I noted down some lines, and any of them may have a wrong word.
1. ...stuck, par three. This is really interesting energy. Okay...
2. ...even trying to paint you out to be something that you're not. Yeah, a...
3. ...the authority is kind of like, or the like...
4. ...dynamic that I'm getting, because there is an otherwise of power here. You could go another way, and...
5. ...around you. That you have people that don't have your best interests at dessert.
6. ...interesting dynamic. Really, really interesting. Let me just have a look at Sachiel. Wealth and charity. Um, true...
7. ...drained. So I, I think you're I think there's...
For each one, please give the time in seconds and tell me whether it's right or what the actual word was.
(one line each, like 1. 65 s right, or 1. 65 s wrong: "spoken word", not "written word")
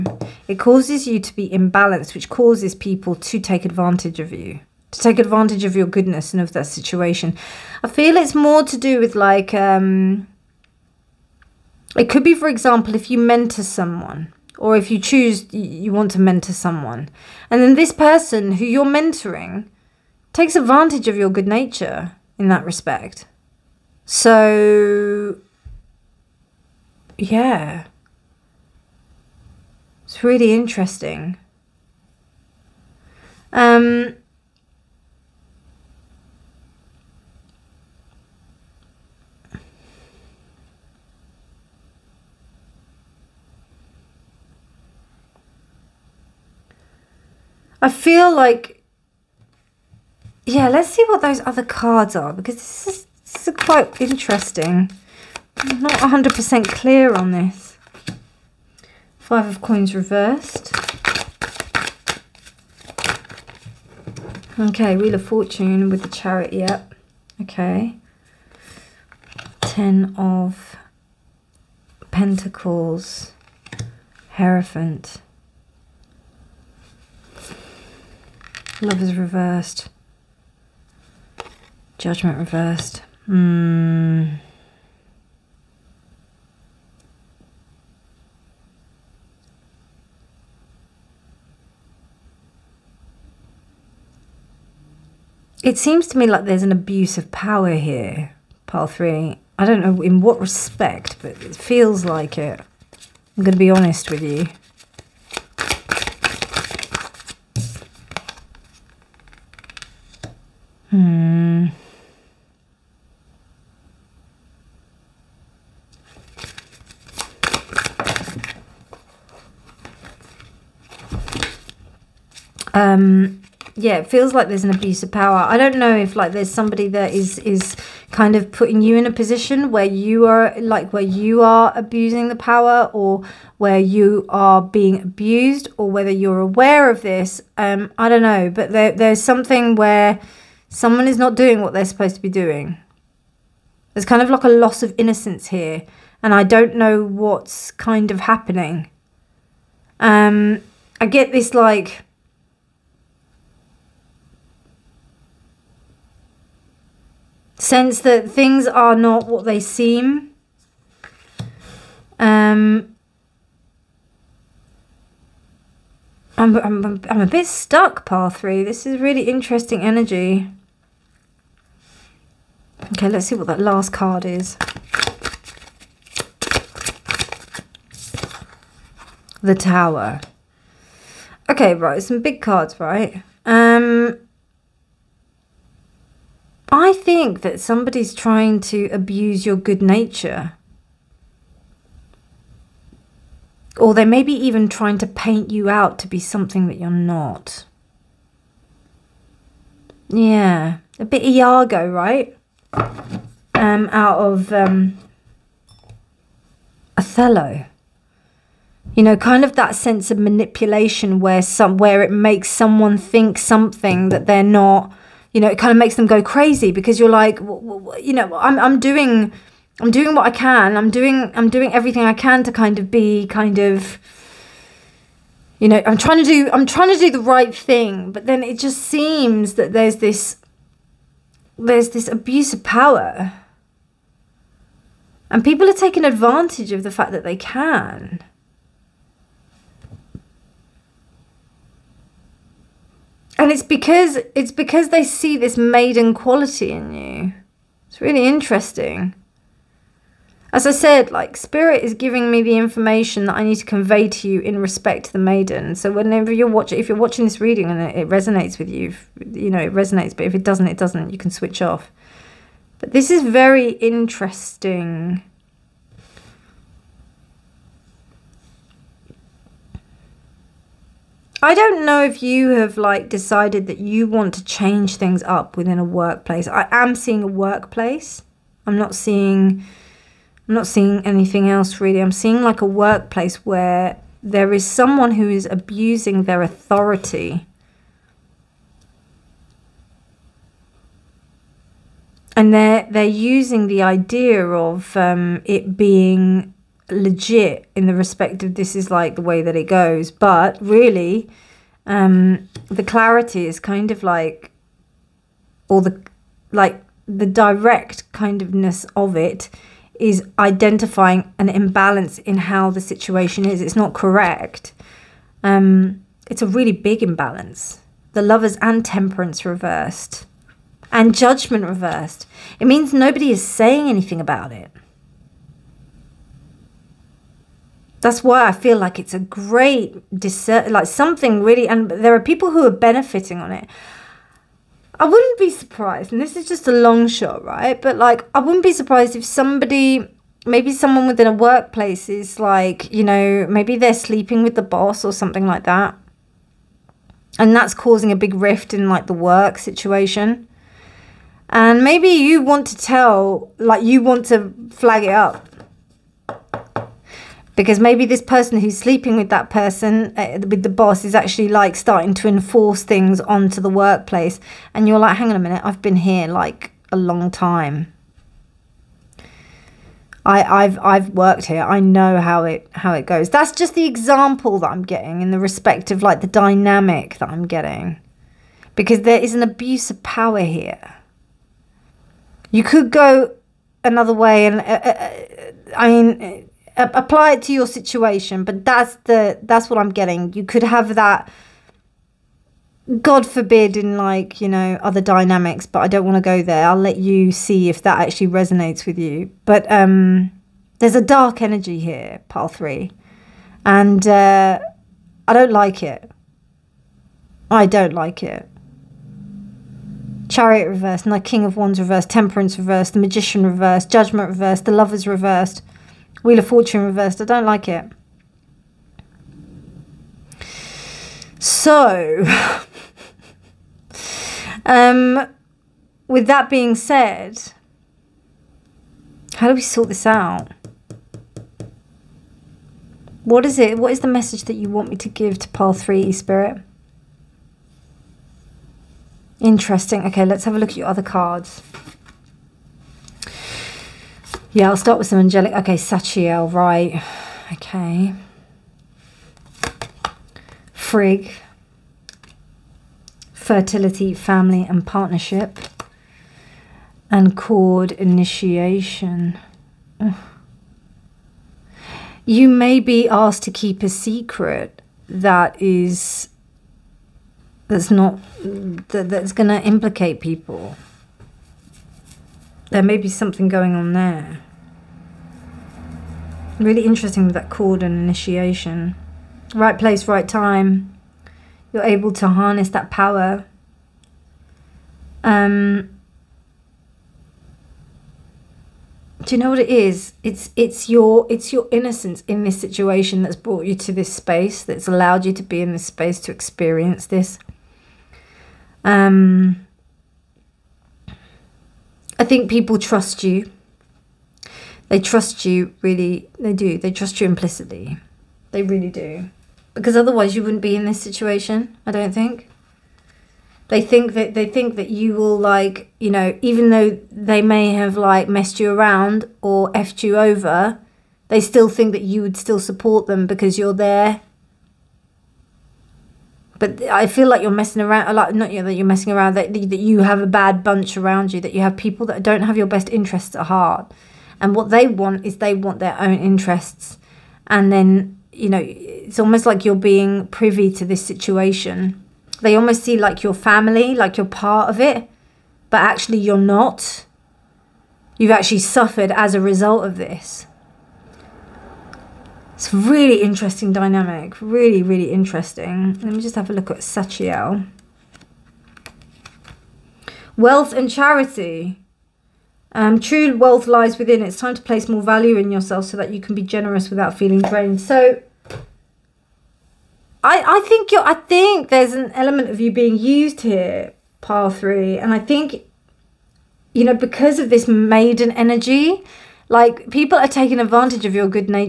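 1. 167 s right
2. 194 s right
3. 302 s wrong: "clarity", not "authority"
4. 376 s wrong: "abuse", not "otherwise"
5. 530 s wrong: "heart", not "dessert"
6. 553 s right
7. 567 s right.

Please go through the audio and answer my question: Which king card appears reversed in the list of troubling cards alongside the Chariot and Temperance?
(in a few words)
King of Wands.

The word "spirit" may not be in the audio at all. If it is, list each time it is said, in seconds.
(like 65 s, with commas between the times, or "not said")
251 s, 436 s.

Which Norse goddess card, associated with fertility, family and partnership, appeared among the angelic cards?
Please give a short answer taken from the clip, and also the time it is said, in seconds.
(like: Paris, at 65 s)
Frigg, at 450 s.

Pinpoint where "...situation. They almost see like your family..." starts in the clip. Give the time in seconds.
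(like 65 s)
541 s.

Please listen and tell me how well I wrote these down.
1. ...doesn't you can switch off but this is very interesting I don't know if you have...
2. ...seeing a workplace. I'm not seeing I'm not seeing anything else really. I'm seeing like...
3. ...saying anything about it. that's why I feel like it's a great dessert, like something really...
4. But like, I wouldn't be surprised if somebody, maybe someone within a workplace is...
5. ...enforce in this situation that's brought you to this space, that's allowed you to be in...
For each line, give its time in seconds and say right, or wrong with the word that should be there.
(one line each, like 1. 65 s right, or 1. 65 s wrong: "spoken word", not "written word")
1. 260 s right
2. 276 s right
3. 323 s right
4. 337 s right
5. 491 s wrong: "innocence", not "enforce".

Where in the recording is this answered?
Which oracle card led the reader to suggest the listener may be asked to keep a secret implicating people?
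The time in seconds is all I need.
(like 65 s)
457 s.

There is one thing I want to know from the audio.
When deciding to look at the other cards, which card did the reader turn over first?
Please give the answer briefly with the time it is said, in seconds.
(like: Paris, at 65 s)
Five of coins reversed, at 59 s.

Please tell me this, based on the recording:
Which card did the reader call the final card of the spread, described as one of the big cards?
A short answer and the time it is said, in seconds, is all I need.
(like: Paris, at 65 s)
The Tower, at 179 s.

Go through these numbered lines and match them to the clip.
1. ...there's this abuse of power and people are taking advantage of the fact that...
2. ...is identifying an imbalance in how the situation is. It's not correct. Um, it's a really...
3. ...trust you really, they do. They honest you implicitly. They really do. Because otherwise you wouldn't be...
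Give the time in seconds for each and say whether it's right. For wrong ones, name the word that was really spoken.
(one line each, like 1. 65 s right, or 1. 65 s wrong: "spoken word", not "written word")
1. 231 s right
2. 309 s right
3. 504 s wrong: "trust", not "honest".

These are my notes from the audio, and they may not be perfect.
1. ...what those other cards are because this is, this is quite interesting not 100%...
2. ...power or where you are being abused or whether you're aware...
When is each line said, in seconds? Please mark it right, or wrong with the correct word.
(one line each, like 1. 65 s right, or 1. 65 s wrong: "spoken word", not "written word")
1. 51 s right
2. 132 s right.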